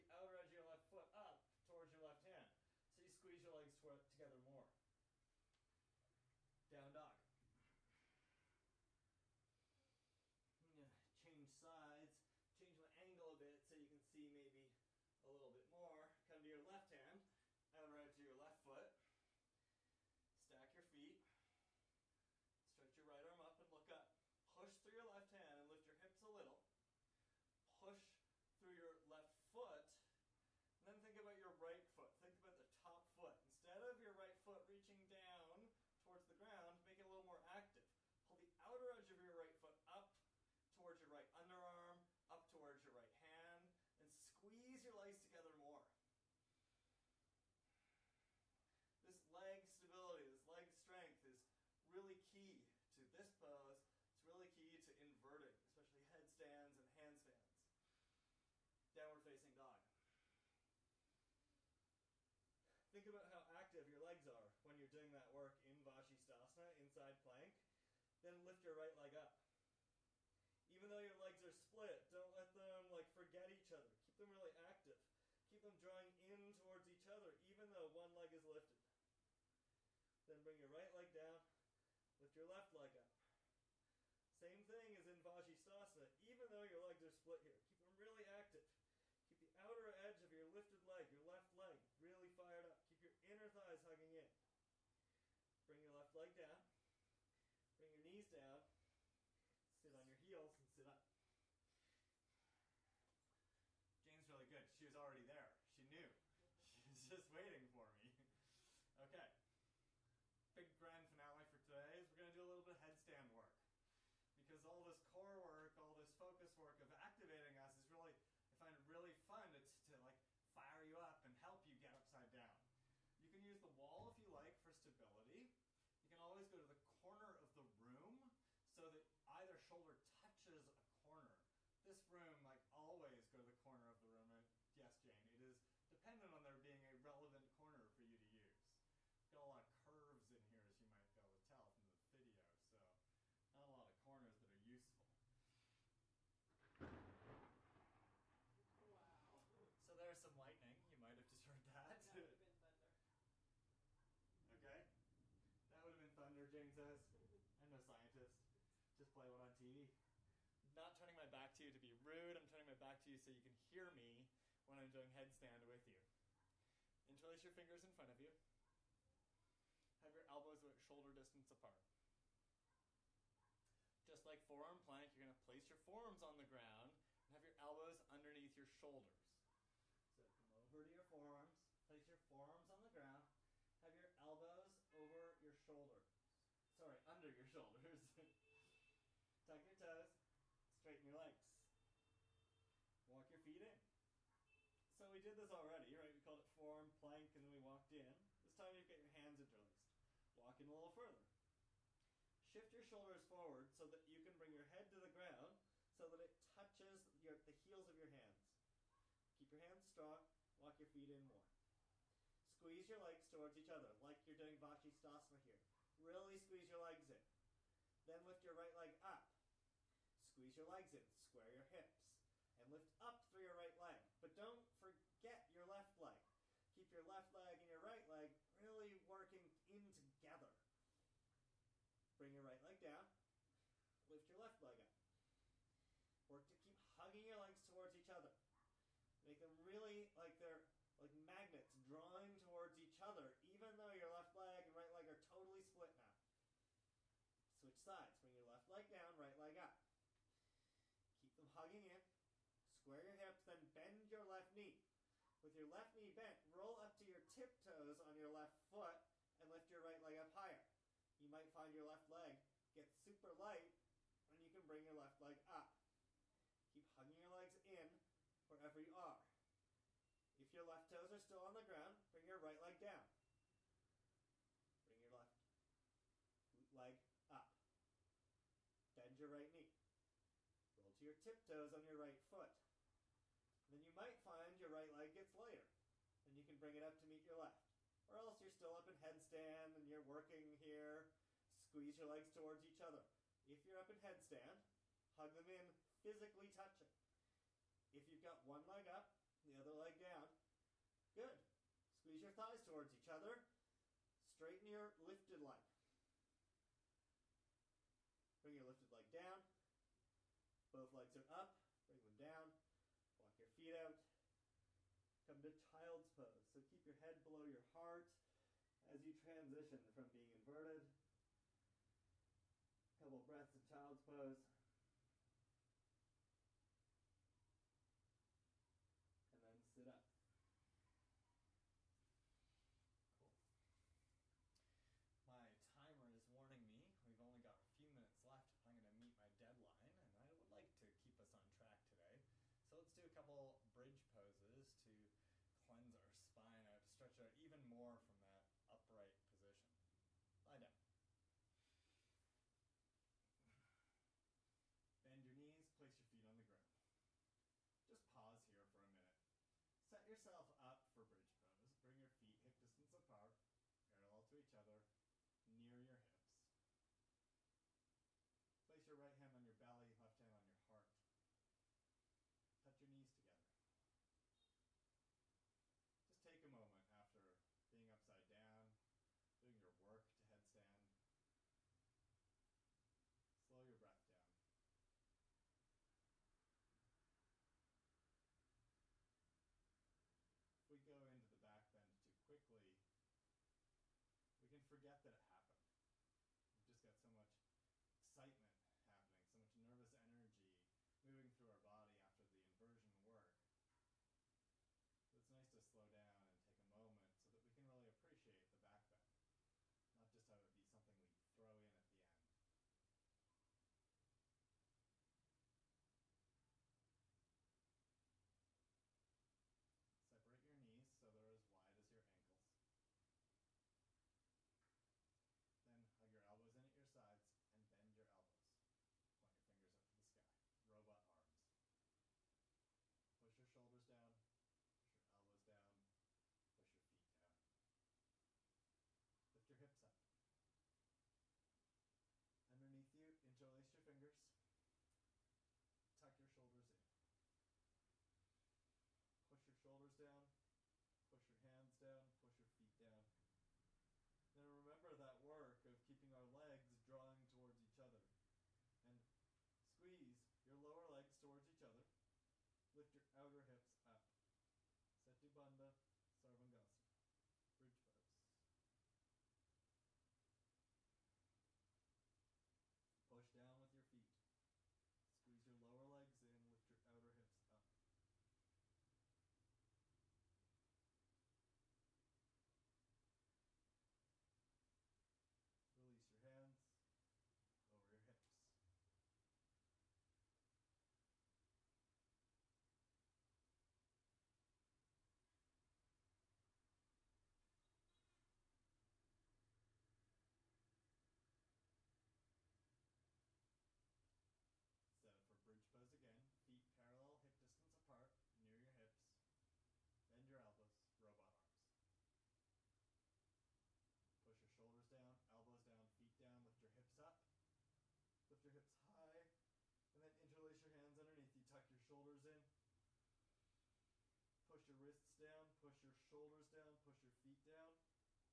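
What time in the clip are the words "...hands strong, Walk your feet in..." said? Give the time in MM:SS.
03:29.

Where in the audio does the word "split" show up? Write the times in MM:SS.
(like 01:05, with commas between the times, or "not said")
01:11, 01:27, 04:05.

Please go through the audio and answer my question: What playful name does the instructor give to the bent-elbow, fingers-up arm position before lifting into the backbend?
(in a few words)
Robot arms.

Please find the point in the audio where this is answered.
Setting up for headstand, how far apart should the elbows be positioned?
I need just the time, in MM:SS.
02:50.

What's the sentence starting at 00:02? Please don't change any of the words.
So you squeeze your legs together more.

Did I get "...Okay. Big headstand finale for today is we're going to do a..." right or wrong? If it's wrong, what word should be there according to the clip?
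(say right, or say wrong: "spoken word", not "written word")
wrong: "grand", not "headstand".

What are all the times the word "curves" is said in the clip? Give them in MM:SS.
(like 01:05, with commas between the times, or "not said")
02:19.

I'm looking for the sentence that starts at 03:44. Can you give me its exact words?
But don't forget your left leg.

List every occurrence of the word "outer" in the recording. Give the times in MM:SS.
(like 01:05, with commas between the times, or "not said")
00:00, 00:38, 01:29, 07:43, 07:56.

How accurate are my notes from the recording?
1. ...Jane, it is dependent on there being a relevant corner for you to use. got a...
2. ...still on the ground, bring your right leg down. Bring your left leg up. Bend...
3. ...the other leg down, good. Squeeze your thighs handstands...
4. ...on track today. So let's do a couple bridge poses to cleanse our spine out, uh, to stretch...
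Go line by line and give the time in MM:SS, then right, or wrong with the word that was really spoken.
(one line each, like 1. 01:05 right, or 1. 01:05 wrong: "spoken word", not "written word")
1. 02:15 right
2. 04:31 right
3. 04:59 wrong: "towards", not "handstands"
4. 05:41 right.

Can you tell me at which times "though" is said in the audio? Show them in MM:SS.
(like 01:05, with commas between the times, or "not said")
01:10, 01:17, 01:26, 04:03.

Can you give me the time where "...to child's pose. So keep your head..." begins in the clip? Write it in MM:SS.
05:15.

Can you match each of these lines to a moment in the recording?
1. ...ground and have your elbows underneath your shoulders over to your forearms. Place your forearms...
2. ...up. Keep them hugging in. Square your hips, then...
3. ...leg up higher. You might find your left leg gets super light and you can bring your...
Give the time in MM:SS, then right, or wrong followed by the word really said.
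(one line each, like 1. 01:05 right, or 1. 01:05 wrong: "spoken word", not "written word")
1. 02:56 right
2. 04:09 right
3. 04:20 right.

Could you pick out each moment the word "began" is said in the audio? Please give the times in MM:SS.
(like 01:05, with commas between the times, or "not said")
not said.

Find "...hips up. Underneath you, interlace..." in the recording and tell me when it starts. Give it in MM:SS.
07:19.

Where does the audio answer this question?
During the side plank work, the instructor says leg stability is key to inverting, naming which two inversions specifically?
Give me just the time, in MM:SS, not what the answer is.
00:56.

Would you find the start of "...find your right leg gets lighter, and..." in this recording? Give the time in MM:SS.
04:44.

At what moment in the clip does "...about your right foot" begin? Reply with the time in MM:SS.
00:31.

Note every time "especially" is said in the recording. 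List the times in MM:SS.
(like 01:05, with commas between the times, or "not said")
00:55.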